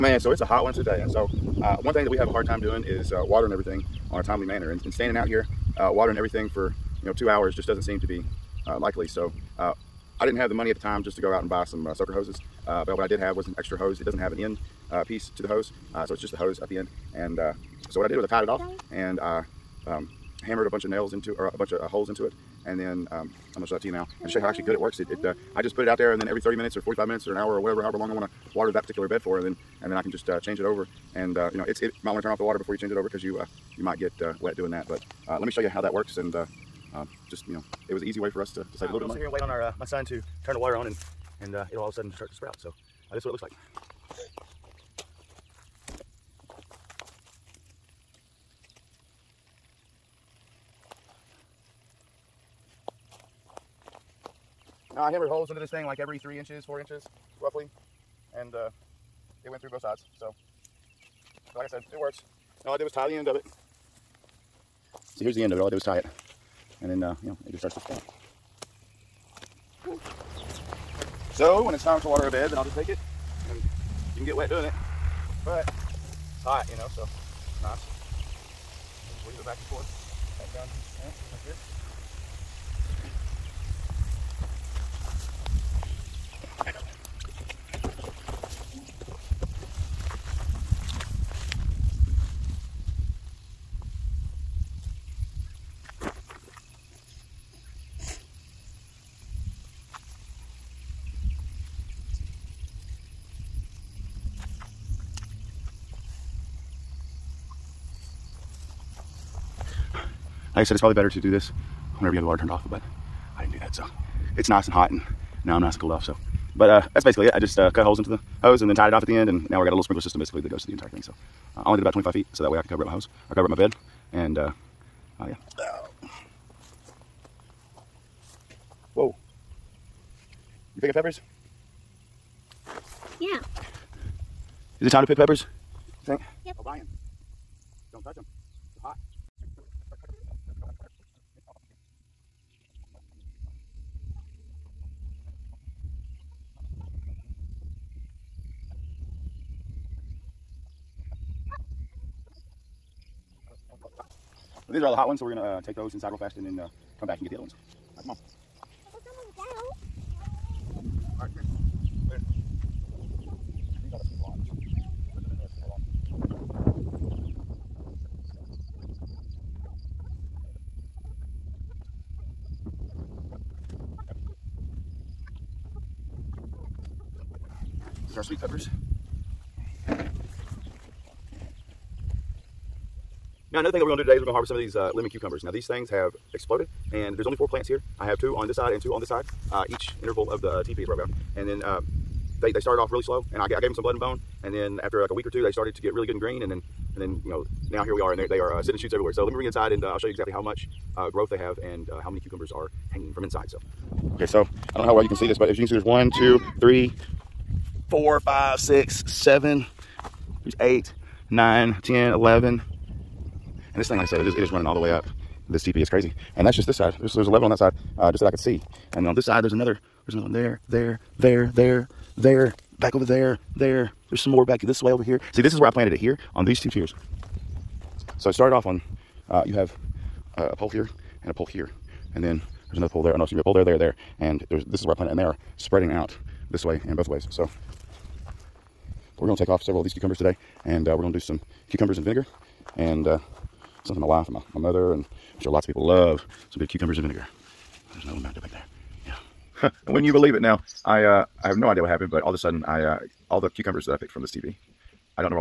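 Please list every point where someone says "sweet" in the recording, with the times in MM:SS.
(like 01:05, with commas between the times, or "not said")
02:58.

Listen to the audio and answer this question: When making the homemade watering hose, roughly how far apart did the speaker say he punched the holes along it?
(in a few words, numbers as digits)
3 to 4 inches.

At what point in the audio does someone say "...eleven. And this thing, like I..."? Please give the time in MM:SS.
03:32.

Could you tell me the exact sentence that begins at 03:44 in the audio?
There's some more back this way over here.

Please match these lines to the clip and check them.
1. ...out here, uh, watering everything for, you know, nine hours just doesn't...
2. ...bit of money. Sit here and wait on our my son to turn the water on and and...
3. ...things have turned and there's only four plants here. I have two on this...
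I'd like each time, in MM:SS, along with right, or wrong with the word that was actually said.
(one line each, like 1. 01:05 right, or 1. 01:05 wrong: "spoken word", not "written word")
1. 00:05 wrong: "two", not "nine"
2. 00:39 right
3. 03:05 wrong: "exploded", not "turned".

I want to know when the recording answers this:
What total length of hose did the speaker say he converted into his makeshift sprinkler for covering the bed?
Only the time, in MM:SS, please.
02:01.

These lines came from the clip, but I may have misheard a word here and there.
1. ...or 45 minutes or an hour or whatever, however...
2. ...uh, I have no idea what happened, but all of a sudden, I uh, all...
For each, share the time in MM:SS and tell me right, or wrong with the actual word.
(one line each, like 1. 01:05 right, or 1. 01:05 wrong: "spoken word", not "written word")
1. 00:26 right
2. 04:11 right.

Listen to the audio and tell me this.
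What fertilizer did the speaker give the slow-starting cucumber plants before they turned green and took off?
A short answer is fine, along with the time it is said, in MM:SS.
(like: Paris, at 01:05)
blood and bone, at 03:13.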